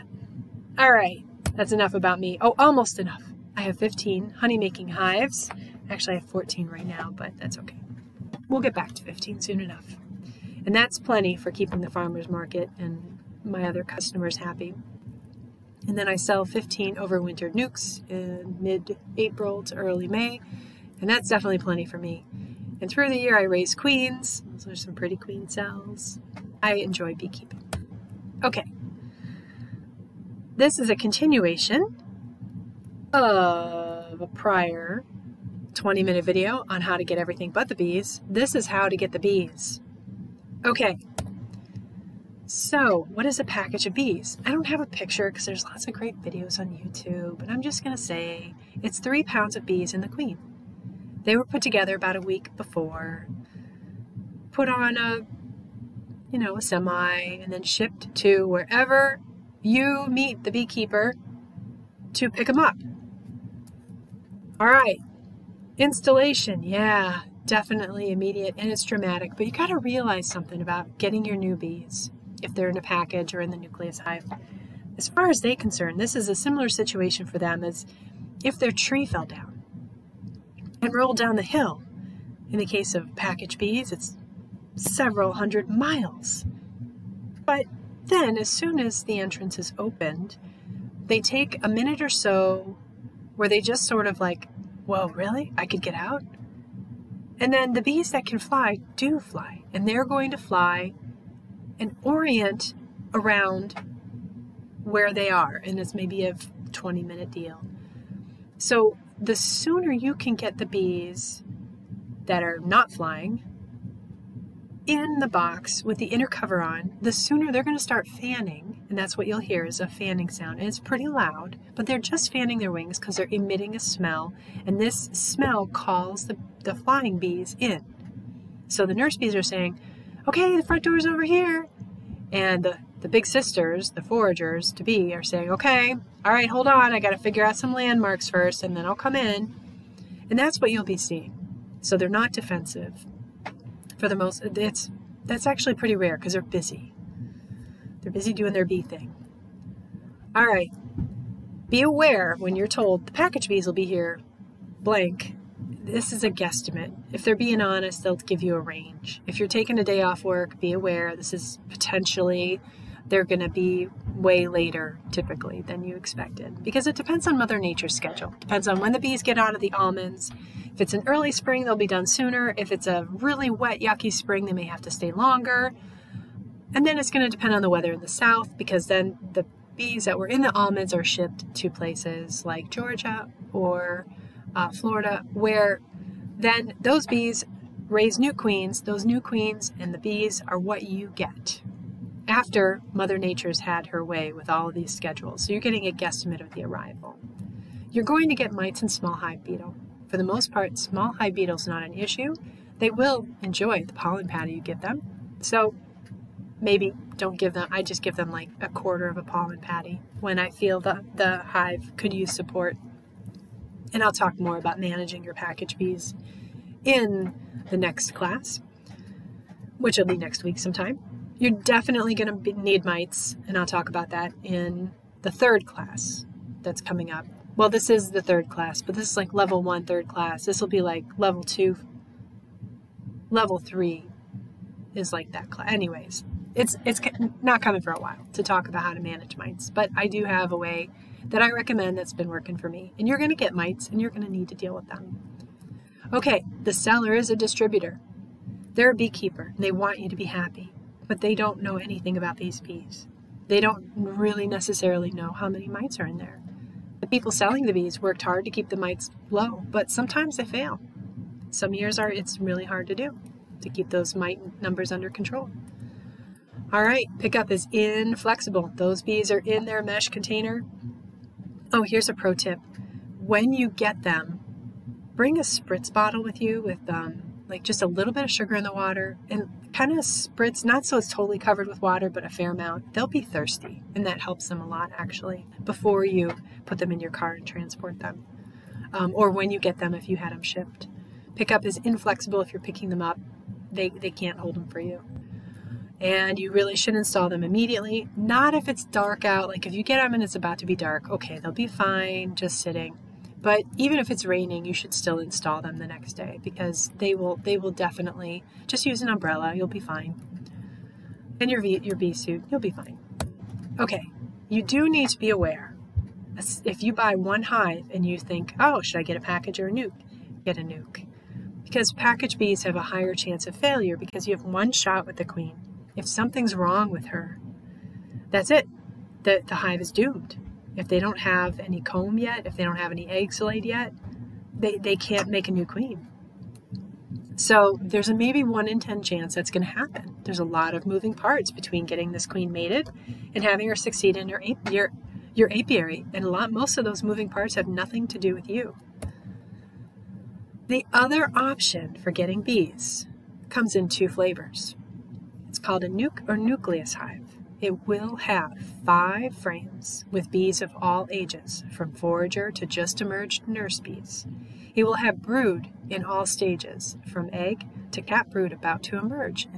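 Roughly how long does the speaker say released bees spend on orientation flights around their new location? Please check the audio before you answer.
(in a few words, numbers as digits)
20 minutes.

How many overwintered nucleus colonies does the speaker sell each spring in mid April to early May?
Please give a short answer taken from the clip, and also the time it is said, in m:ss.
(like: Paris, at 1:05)
15, at 0:16.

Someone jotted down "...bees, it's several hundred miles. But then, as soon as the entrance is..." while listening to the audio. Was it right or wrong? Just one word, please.
right.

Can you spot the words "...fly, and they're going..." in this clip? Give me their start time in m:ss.
1:39.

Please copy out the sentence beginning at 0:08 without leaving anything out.
We'll get back to 15 soon enough.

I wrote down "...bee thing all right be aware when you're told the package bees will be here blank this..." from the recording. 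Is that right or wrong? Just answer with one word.
right.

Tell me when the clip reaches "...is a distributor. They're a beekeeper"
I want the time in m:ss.
4:07.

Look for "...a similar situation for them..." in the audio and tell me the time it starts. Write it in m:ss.
1:16.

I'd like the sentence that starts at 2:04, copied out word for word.
And this smell calls the, the flying bees in.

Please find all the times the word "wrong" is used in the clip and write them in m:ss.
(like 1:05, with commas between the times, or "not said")
5:26.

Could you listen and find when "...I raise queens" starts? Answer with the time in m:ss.
0:23.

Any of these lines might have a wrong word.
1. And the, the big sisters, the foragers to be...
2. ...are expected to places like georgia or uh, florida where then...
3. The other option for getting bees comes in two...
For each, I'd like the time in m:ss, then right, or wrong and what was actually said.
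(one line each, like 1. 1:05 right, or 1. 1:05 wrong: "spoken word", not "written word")
1. 2:12 right
2. 3:00 wrong: "shipped", not "expected"
3. 5:50 right.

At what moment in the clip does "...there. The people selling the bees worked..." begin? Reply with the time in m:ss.
4:16.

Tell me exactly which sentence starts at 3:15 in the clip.
So you're getting a guesstimate of the arrival.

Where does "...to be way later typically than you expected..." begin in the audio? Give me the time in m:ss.
2:43.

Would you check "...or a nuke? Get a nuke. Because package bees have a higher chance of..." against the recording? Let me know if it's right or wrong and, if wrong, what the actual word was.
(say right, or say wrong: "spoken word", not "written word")
right.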